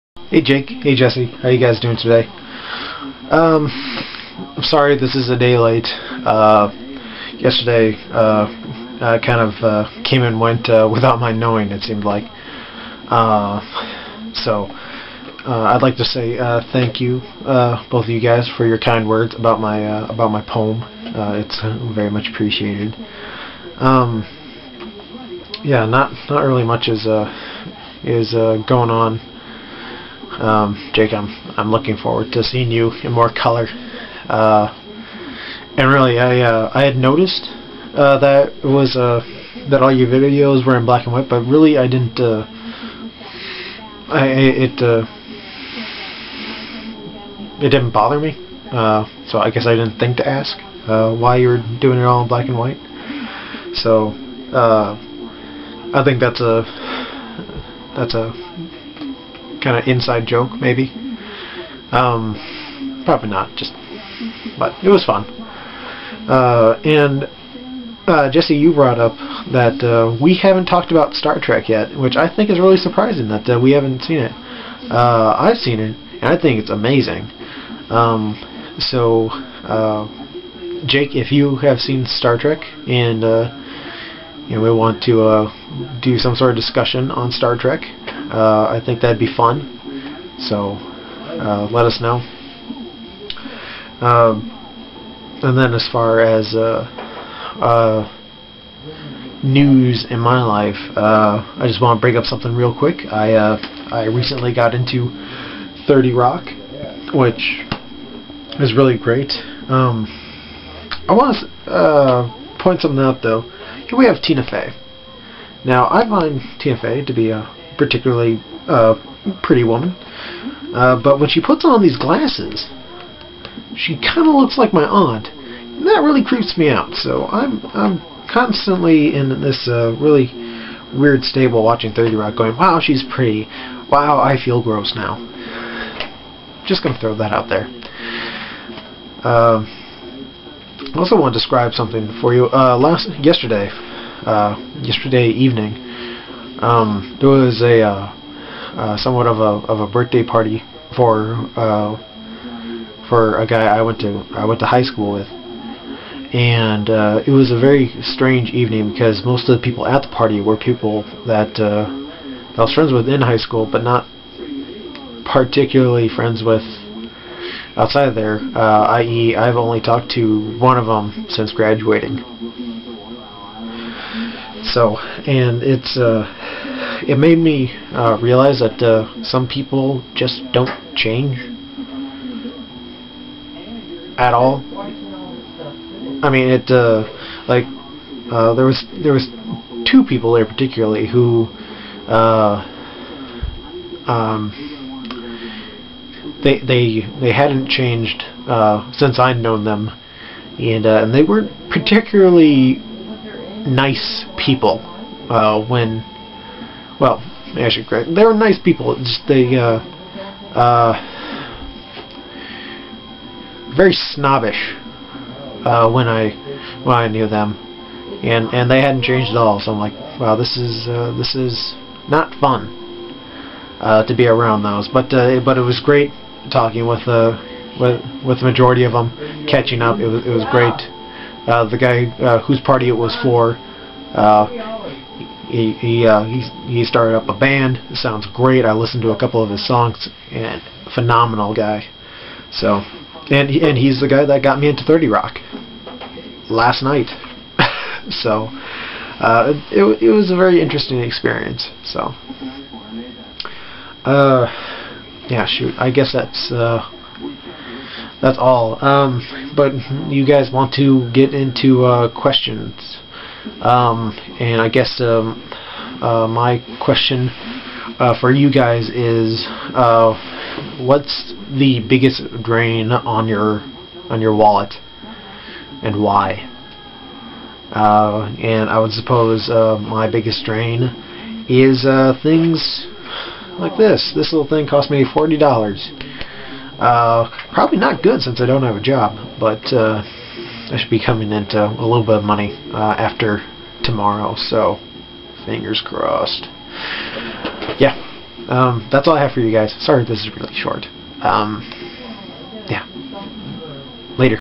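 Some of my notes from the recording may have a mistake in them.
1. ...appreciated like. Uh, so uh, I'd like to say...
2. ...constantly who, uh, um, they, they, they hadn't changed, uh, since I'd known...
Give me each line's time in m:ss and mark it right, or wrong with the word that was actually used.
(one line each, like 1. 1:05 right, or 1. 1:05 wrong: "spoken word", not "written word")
1. 0:11 wrong: "seemed", not "appreciated"
2. 3:10 wrong: "particularly", not "constantly".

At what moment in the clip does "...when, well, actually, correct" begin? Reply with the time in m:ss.
3:25.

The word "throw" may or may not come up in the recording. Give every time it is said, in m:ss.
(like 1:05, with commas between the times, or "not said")
2:17.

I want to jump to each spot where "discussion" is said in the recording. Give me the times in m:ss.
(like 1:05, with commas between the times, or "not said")
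1:26.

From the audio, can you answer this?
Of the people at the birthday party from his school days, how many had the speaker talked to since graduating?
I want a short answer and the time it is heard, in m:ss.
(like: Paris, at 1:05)
1, at 2:50.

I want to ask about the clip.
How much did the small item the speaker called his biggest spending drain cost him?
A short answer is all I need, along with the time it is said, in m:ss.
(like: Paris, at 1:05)
$40, at 4:45.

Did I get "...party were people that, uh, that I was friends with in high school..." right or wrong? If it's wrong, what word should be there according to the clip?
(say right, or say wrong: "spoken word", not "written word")
right.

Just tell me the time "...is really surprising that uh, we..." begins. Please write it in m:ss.
1:12.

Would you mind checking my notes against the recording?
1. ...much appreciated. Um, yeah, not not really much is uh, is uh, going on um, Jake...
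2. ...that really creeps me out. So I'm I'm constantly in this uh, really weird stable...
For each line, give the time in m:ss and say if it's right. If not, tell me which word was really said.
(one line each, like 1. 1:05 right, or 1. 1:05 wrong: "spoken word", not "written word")
1. 0:22 right
2. 2:05 right.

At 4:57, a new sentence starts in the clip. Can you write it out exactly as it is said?
Yeah, um, that's all I have for you guys.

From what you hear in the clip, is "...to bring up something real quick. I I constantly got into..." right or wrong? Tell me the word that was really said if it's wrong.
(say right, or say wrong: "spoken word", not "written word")
wrong: "recently", not "constantly".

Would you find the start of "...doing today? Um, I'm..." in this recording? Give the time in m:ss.
0:01.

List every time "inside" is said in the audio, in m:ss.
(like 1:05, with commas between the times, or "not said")
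0:59.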